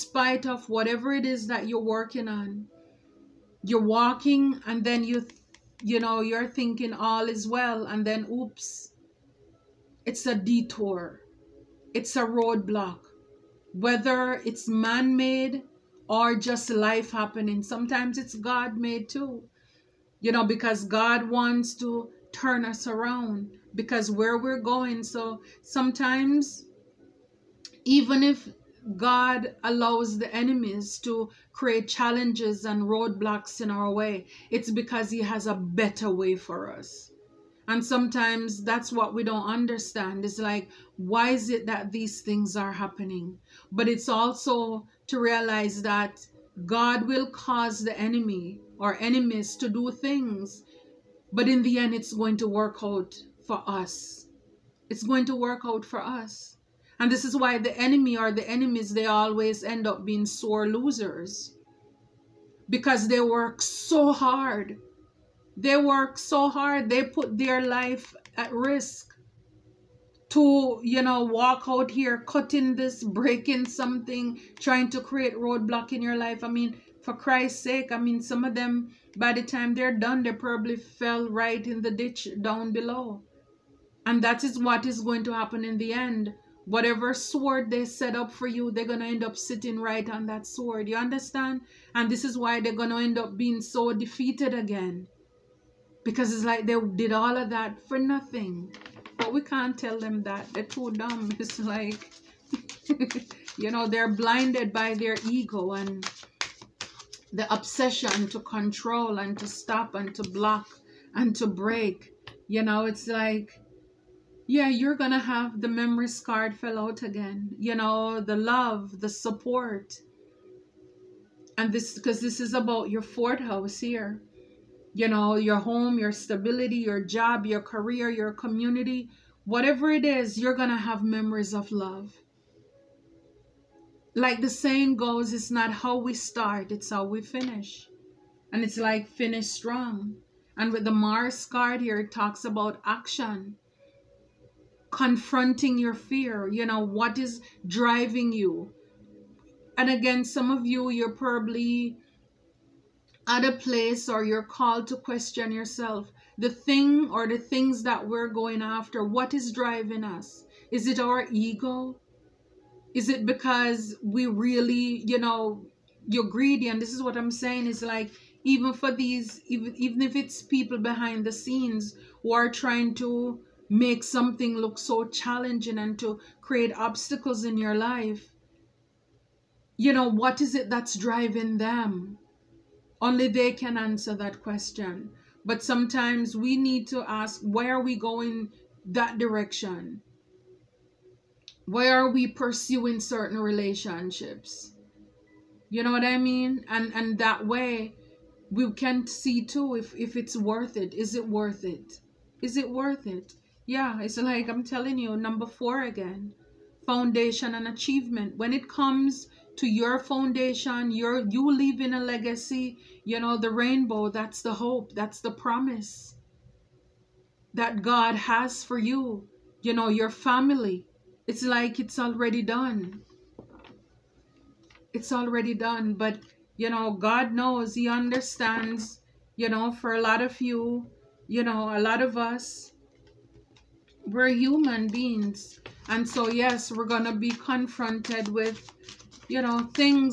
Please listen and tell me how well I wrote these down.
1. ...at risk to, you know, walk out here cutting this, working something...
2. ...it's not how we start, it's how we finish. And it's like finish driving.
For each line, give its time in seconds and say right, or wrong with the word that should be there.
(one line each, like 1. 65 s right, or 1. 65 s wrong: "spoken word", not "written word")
1. 68 s wrong: "breaking", not "working"
2. 135 s wrong: "strong", not "driving".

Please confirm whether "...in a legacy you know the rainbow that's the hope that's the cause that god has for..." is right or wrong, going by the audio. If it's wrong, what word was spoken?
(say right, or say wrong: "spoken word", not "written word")
wrong: "promise", not "cause".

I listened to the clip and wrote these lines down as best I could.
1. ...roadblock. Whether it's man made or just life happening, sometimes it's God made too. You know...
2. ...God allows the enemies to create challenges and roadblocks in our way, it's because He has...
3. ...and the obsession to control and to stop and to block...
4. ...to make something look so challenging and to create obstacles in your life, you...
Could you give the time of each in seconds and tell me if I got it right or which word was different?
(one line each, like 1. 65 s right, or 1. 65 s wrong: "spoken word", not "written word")
1. 12 s right
2. 28 s right
3. 105 s right
4. 172 s right.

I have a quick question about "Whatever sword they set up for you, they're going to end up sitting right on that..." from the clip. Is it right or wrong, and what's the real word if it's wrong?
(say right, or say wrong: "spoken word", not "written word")
right.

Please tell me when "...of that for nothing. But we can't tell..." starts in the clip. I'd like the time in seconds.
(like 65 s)
97 s.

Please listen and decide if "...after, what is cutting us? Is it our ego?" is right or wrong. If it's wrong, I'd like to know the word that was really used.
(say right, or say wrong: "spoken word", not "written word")
wrong: "driving", not "cutting".